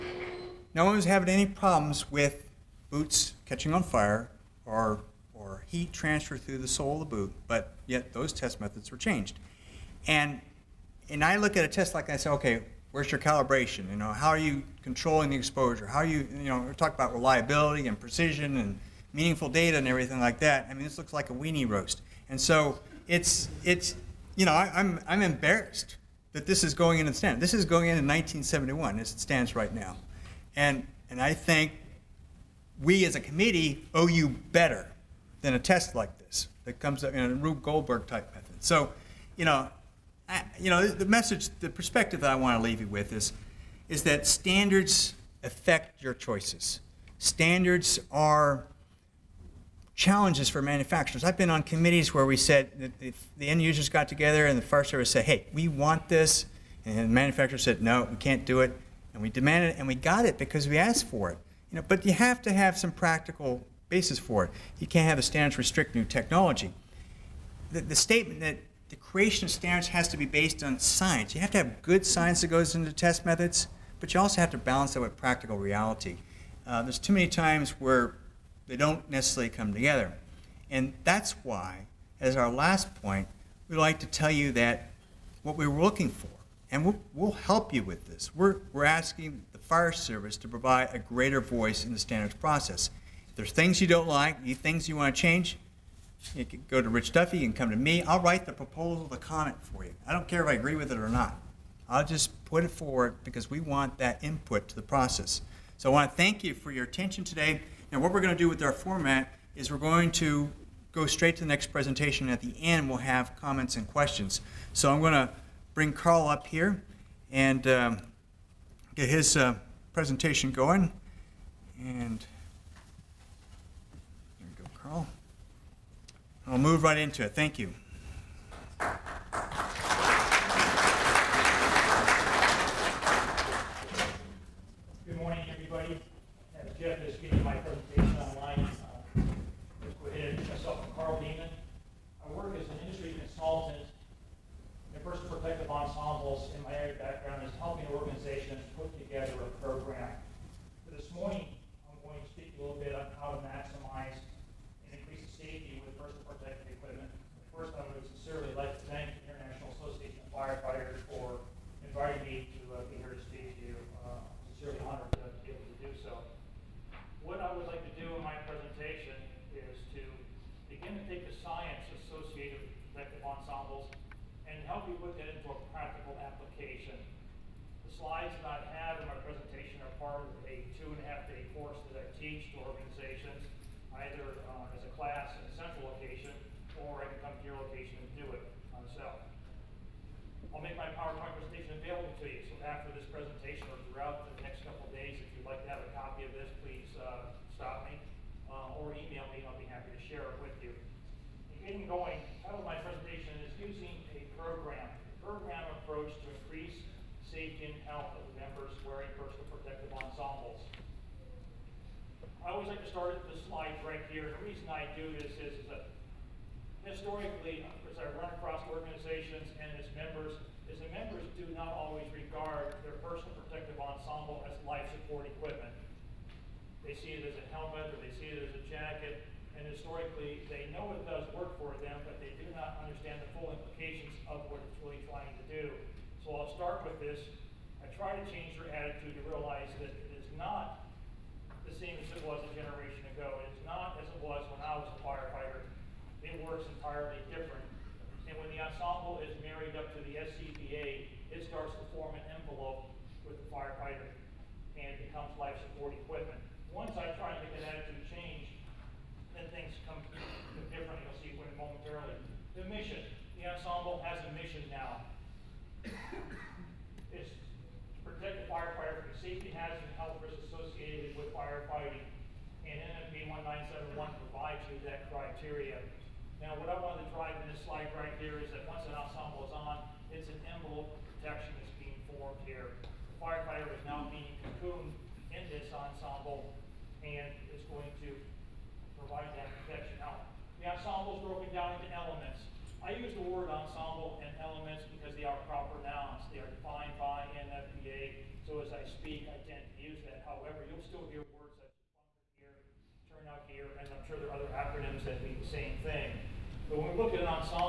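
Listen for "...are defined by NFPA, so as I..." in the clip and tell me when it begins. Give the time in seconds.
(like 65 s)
296 s.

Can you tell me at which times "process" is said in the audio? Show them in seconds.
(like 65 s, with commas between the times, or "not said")
92 s, 104 s.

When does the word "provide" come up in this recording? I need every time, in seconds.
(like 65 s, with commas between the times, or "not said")
90 s, 274 s, 288 s.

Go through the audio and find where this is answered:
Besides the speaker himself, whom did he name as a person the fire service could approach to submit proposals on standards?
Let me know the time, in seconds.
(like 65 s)
96 s.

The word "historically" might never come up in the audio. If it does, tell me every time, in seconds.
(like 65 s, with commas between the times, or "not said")
216 s, 229 s.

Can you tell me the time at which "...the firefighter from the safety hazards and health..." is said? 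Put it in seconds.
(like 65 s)
268 s.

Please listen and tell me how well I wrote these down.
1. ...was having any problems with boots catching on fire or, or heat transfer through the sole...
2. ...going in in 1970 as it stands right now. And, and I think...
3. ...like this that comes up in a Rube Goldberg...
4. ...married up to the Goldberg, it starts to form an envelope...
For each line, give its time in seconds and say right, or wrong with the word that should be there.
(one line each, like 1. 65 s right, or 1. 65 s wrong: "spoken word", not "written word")
1. 0 s right
2. 27 s wrong: "1971", not "1970"
3. 35 s right
4. 249 s wrong: "SCBA", not "Goldberg".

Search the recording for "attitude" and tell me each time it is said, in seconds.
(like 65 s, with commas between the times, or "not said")
238 s, 257 s.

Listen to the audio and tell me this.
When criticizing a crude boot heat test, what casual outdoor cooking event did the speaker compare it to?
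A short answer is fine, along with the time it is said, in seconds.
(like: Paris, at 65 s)
a weenie roast, at 21 s.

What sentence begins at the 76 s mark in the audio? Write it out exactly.
Uh, there's too many times where they don't necessarily come together.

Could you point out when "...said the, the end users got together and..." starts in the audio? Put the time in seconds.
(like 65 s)
52 s.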